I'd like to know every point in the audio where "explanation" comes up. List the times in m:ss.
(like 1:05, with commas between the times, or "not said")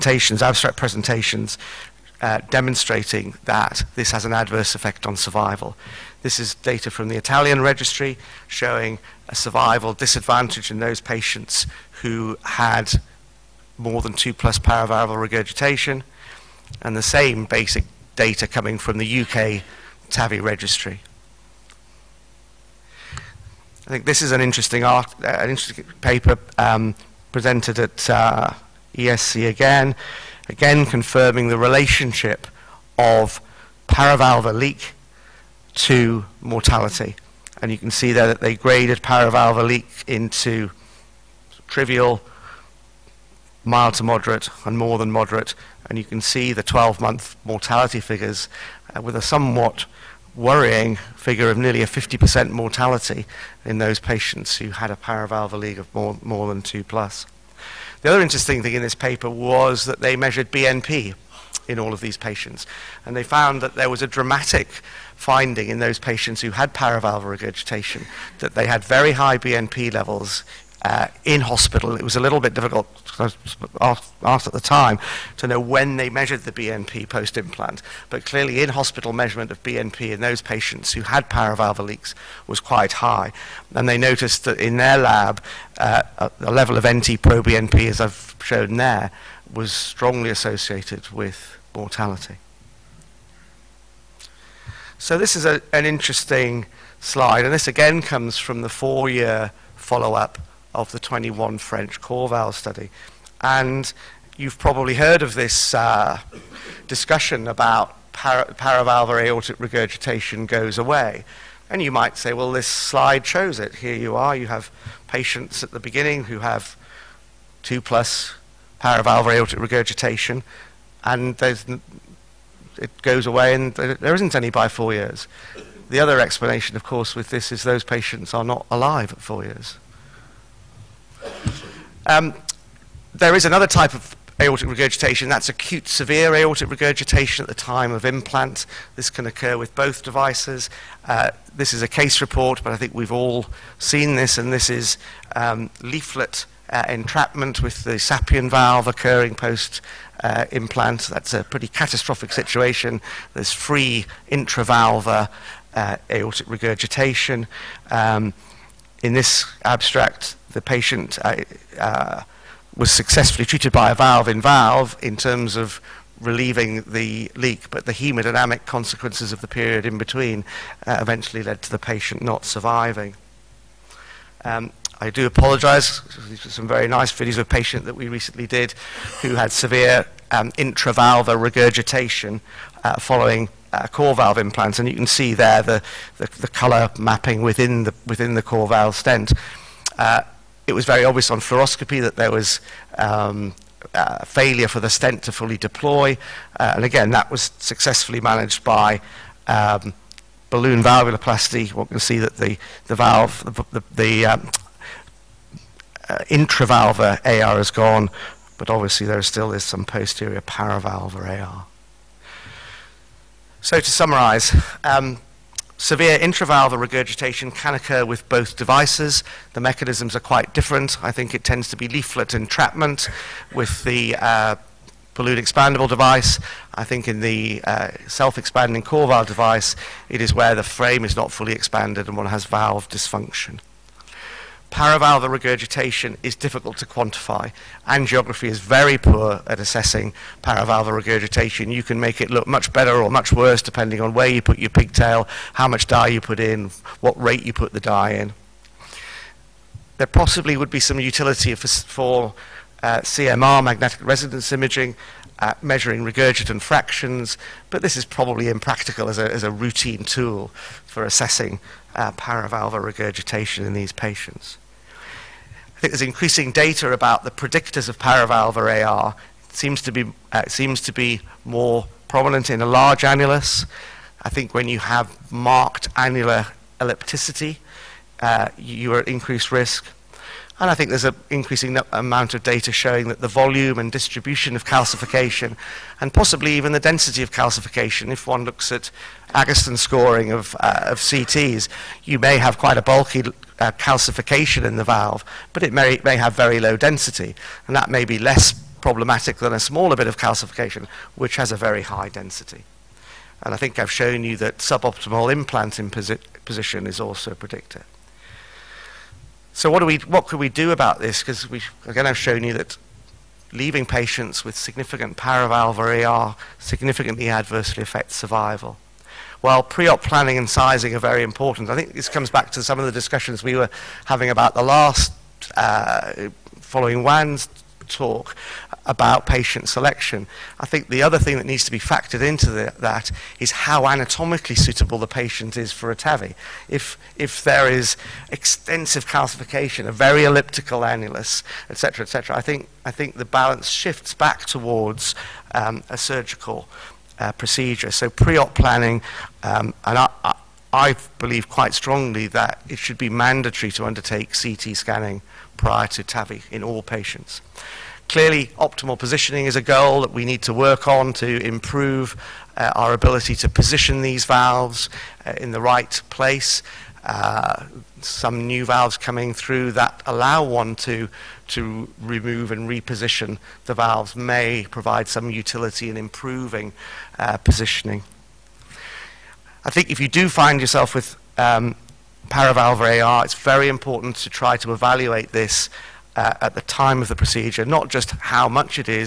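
2:06.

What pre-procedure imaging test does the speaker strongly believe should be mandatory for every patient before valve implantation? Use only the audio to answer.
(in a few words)
CT scanning.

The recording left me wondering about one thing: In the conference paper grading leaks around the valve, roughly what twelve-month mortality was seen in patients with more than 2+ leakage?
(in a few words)
nearly 50%.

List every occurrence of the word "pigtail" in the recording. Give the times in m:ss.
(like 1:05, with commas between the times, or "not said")
4:04.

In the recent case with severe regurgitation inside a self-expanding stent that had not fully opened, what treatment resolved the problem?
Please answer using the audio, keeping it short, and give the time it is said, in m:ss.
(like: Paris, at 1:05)
balloon valvuloplasty, at 3:20.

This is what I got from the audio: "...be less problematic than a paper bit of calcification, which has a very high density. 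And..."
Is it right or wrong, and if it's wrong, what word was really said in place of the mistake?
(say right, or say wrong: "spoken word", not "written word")
wrong: "smaller", not "paper".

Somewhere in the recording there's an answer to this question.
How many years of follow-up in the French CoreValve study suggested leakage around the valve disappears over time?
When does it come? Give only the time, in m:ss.
1:38.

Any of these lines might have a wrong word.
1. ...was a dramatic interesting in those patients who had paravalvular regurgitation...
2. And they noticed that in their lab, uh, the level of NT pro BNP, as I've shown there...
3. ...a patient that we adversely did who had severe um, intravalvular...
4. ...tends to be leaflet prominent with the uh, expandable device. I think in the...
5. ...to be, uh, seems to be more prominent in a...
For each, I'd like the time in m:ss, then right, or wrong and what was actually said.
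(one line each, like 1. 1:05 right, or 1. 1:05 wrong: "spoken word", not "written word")
1. 1:03 wrong: "finding", not "interesting"
2. 1:23 right
3. 2:57 wrong: "recently", not "adversely"
4. 3:41 wrong: "entrapment", not "prominent"
5. 4:29 right.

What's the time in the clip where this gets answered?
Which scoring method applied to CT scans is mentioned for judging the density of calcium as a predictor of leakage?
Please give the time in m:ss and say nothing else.
4:49.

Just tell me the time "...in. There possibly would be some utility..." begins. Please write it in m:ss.
4:08.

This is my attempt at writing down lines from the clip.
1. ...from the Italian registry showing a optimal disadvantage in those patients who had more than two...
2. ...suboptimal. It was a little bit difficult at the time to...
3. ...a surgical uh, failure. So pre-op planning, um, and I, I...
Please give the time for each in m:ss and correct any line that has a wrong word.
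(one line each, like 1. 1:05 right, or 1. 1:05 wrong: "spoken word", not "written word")
1. 0:06 wrong: "survival", not "optimal"
2. 1:11 wrong: "hospital", not "suboptimal"
3. 5:45 wrong: "procedure", not "failure".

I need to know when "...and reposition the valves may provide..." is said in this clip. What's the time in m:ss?
6:12.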